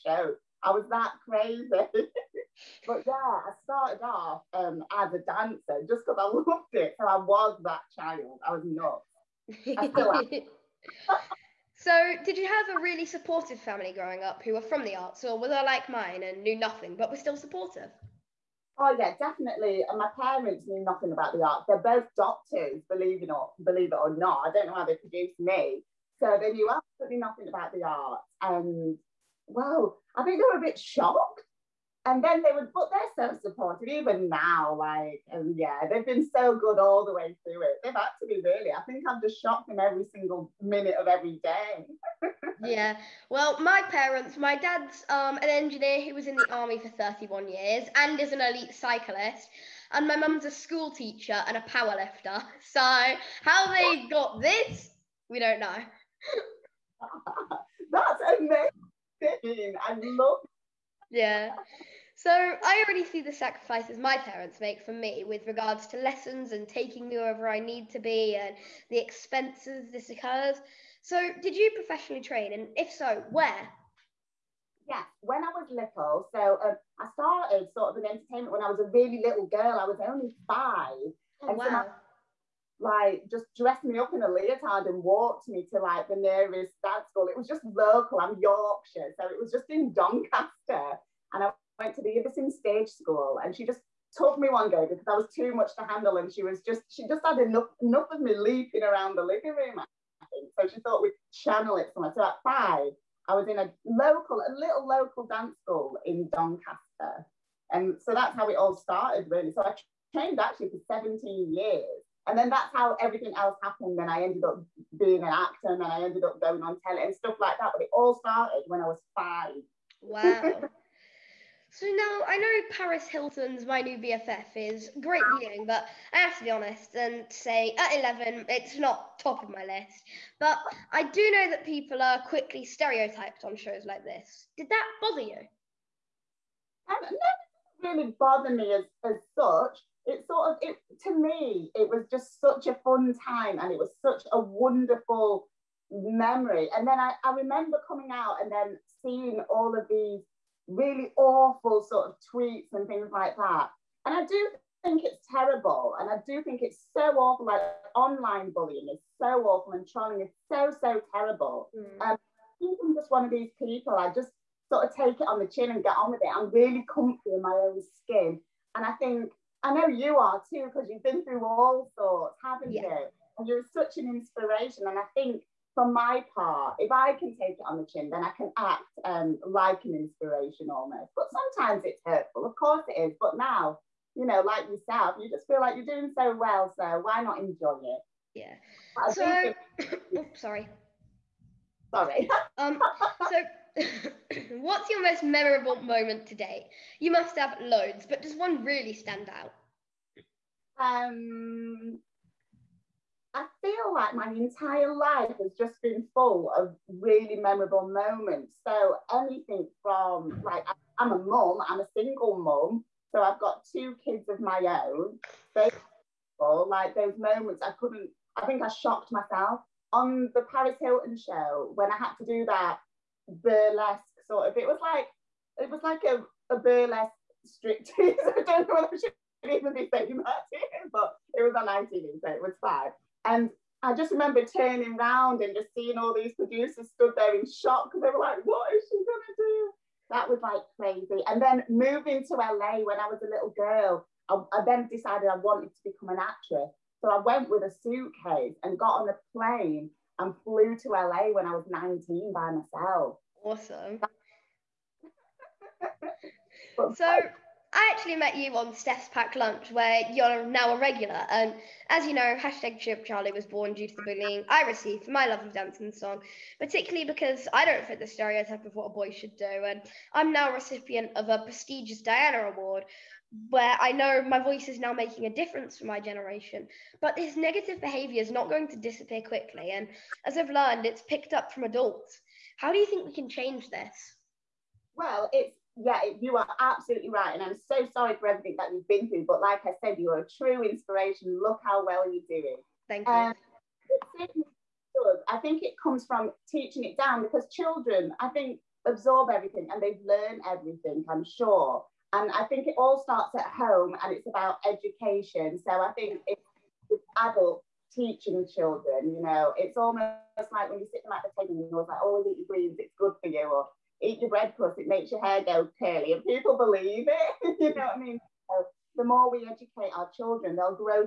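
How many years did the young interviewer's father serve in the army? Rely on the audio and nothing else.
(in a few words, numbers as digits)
31.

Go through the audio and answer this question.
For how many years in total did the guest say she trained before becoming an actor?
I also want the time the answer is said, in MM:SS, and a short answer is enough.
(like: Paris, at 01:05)
17, at 01:51.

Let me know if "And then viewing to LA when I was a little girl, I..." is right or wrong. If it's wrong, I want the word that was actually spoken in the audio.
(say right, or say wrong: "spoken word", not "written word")
wrong: "moving", not "viewing".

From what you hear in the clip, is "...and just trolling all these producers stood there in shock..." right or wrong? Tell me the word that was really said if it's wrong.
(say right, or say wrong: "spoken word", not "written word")
wrong: "seeing", not "trolling".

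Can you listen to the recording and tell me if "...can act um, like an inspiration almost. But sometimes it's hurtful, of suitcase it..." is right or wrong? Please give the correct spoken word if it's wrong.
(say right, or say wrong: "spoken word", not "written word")
wrong: "course", not "suitcase".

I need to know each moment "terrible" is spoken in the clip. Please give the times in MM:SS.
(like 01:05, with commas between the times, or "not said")
02:35, 02:41.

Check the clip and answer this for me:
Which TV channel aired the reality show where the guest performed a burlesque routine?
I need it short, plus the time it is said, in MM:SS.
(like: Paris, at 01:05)
ITV, at 03:51.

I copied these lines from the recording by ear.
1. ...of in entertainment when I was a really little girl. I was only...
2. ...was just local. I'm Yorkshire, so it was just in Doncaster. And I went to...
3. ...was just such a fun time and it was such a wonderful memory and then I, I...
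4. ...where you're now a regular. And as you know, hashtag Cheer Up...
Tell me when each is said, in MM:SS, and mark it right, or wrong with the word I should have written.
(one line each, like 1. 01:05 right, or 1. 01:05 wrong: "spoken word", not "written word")
1. 01:17 right
2. 01:27 right
3. 02:21 right
4. 04:19 right.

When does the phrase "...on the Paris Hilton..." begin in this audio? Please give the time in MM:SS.
03:39.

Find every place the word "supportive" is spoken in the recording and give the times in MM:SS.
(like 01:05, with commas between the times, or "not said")
00:13, 00:17, 00:33.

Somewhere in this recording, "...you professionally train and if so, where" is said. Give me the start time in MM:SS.
01:11.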